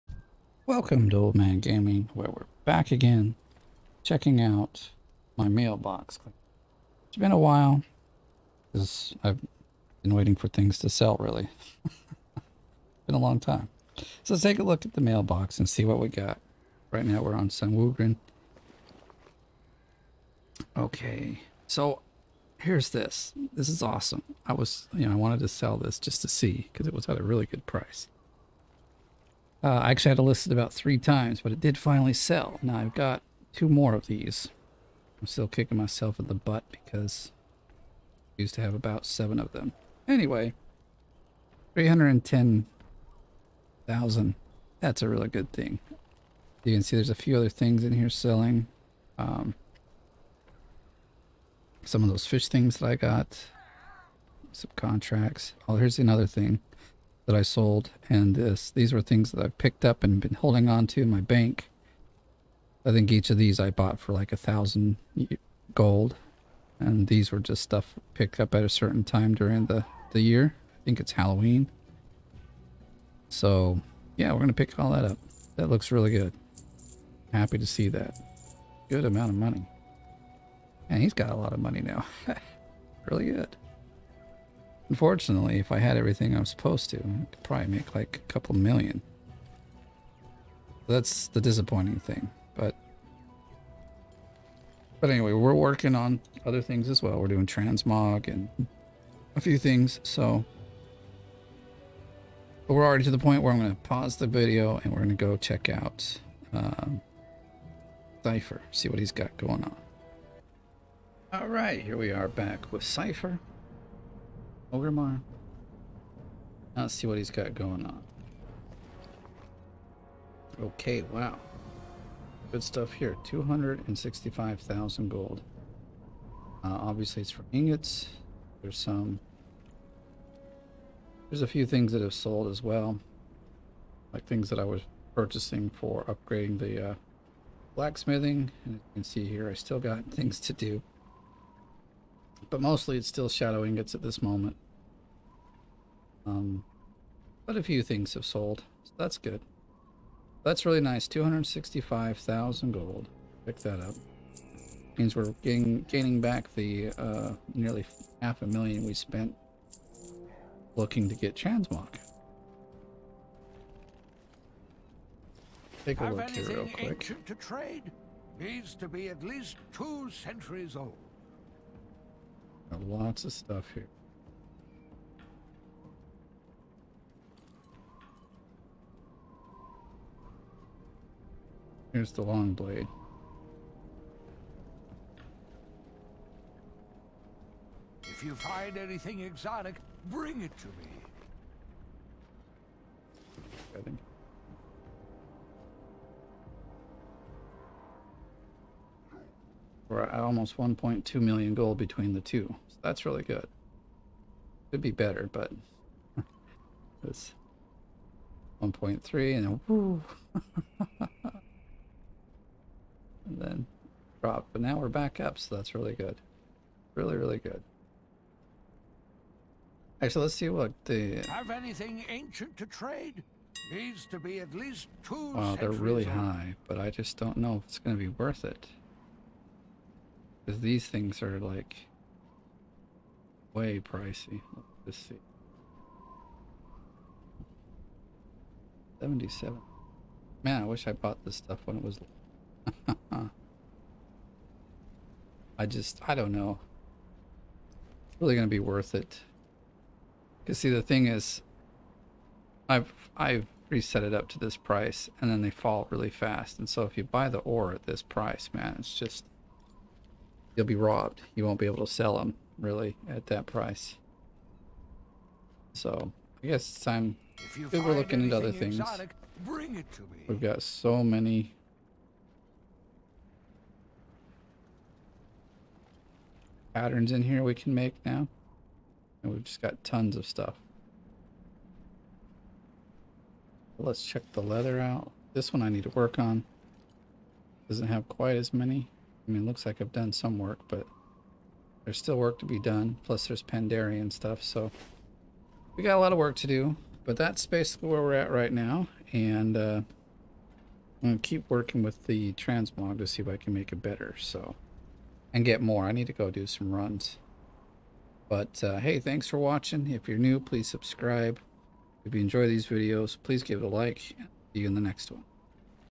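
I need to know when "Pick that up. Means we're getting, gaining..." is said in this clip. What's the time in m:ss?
2:33.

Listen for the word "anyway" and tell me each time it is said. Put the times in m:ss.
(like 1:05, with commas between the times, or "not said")
0:40, 1:35.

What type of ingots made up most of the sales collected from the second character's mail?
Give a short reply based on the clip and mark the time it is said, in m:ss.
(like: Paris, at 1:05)
Shadow ingots, at 2:23.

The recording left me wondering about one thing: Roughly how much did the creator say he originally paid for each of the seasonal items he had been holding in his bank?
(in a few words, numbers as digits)
1,000 gold.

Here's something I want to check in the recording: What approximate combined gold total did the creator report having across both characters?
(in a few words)
1.2 million gold.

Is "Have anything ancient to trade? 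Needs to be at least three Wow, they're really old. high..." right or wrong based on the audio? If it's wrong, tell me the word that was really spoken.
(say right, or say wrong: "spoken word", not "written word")
wrong: "two", not "three".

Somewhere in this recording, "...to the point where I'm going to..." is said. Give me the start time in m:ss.
1:43.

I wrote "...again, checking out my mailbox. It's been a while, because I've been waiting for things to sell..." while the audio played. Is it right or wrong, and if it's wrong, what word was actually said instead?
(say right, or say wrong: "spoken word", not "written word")
right.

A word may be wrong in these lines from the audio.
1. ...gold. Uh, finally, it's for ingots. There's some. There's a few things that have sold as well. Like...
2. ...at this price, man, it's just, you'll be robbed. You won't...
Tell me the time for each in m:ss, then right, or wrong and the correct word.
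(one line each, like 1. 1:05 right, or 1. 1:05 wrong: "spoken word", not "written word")
1. 2:05 wrong: "obviously", not "finally"
2. 4:17 right.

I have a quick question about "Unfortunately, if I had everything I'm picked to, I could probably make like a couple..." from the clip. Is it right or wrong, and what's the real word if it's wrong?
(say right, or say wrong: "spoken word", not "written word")
wrong: "supposed", not "picked".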